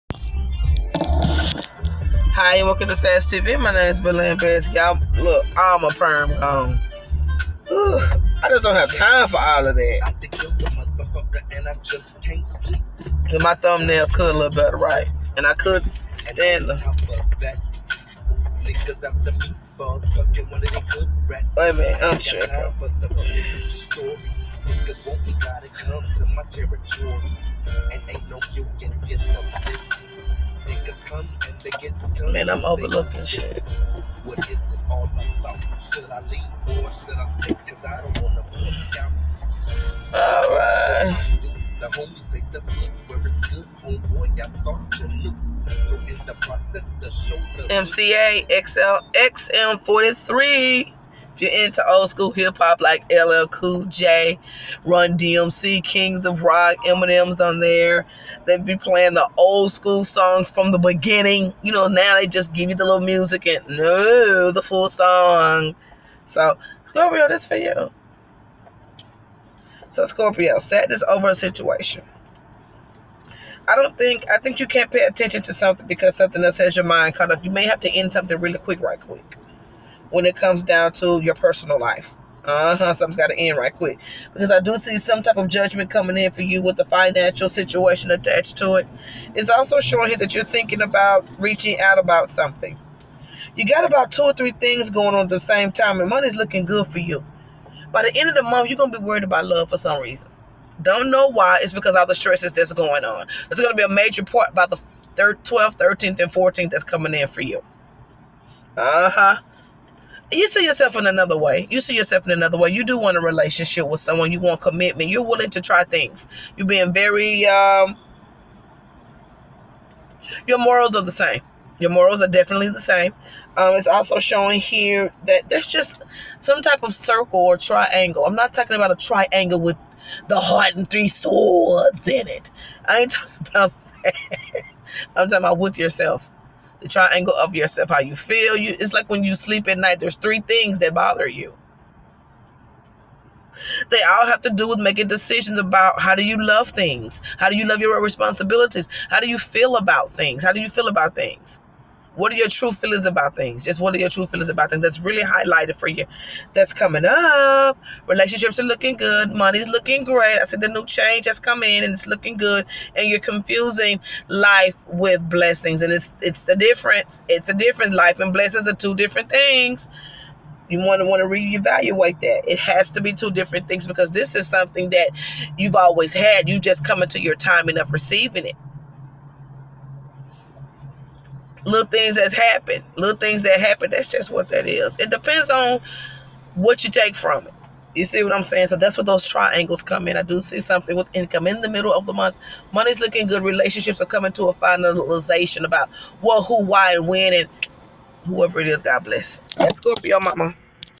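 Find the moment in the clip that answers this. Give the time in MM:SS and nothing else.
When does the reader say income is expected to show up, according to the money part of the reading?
03:11.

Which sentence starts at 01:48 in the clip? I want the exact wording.
Uh huh you see yourself in another way.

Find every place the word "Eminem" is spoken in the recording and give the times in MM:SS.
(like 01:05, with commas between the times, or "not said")
00:56.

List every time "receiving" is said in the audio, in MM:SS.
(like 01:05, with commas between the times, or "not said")
02:57.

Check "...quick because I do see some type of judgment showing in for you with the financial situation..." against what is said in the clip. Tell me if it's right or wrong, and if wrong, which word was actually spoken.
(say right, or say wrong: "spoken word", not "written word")
wrong: "coming", not "showing".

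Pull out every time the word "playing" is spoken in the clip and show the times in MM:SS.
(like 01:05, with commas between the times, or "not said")
00:58.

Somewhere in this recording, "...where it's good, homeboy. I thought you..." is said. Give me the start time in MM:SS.
00:43.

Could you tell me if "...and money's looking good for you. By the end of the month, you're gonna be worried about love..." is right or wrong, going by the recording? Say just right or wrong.
right.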